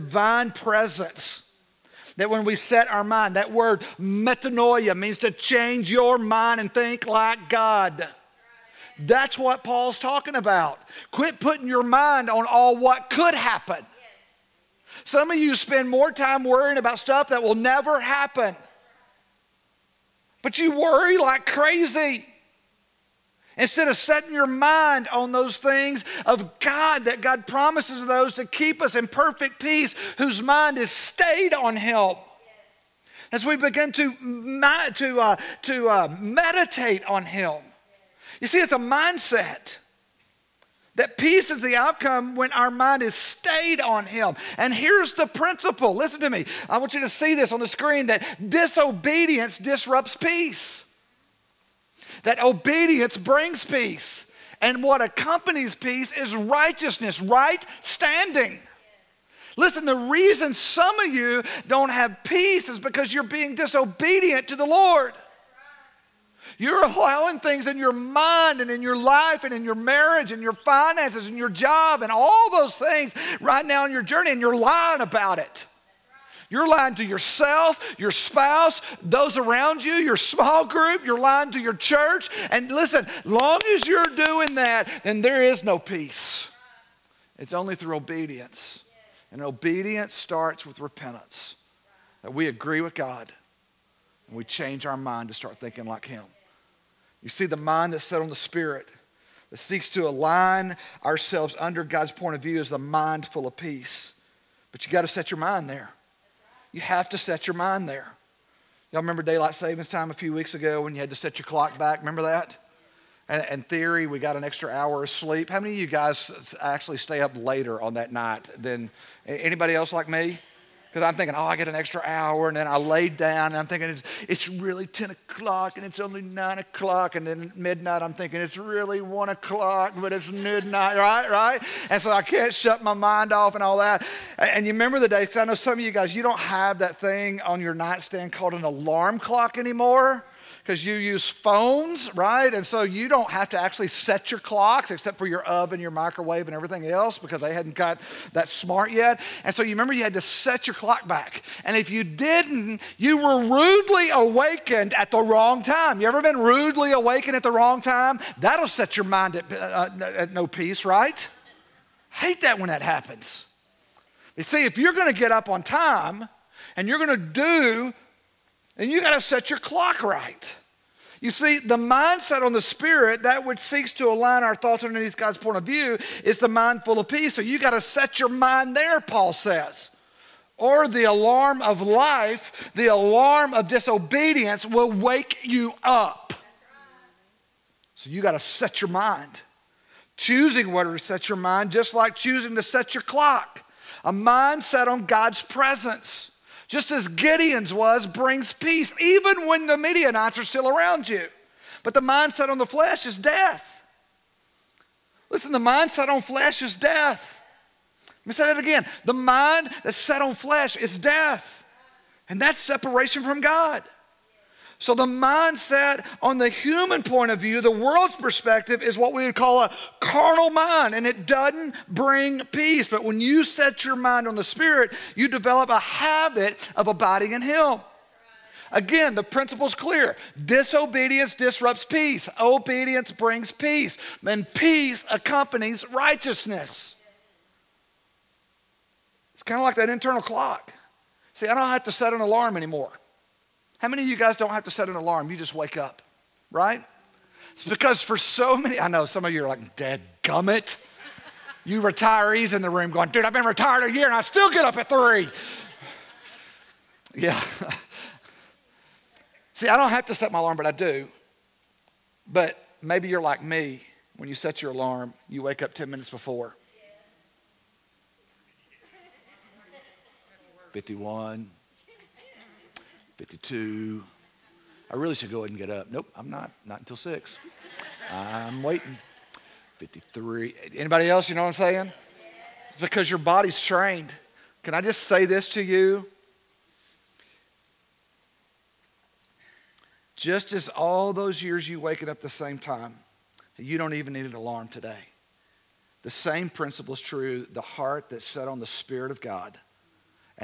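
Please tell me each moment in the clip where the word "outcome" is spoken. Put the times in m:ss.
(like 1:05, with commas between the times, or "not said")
0:41.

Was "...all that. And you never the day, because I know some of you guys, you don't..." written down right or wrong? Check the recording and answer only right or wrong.
wrong.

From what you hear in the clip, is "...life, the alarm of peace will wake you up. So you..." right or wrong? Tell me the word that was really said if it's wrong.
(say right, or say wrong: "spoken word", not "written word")
wrong: "disobedience", not "peace".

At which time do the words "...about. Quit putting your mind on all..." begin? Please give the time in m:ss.
0:10.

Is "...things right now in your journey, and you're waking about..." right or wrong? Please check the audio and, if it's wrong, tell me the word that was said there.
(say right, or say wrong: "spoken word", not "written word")
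wrong: "lying", not "waking".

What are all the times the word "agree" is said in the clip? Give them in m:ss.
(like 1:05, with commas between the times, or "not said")
1:32.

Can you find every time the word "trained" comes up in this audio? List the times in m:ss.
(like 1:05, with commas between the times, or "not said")
4:43.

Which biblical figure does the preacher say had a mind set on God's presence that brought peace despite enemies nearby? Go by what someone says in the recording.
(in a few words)
Gideon.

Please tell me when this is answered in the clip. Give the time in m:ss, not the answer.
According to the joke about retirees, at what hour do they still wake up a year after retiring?
4:14.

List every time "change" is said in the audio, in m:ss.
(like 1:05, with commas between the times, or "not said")
0:05, 1:34.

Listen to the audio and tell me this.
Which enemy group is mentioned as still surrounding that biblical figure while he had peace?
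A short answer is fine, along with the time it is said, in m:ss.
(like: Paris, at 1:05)
Midianites, at 3:19.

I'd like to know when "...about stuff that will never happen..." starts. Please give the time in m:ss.
0:16.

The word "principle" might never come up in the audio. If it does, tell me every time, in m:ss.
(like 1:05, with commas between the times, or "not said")
0:45, 3:49, 4:56.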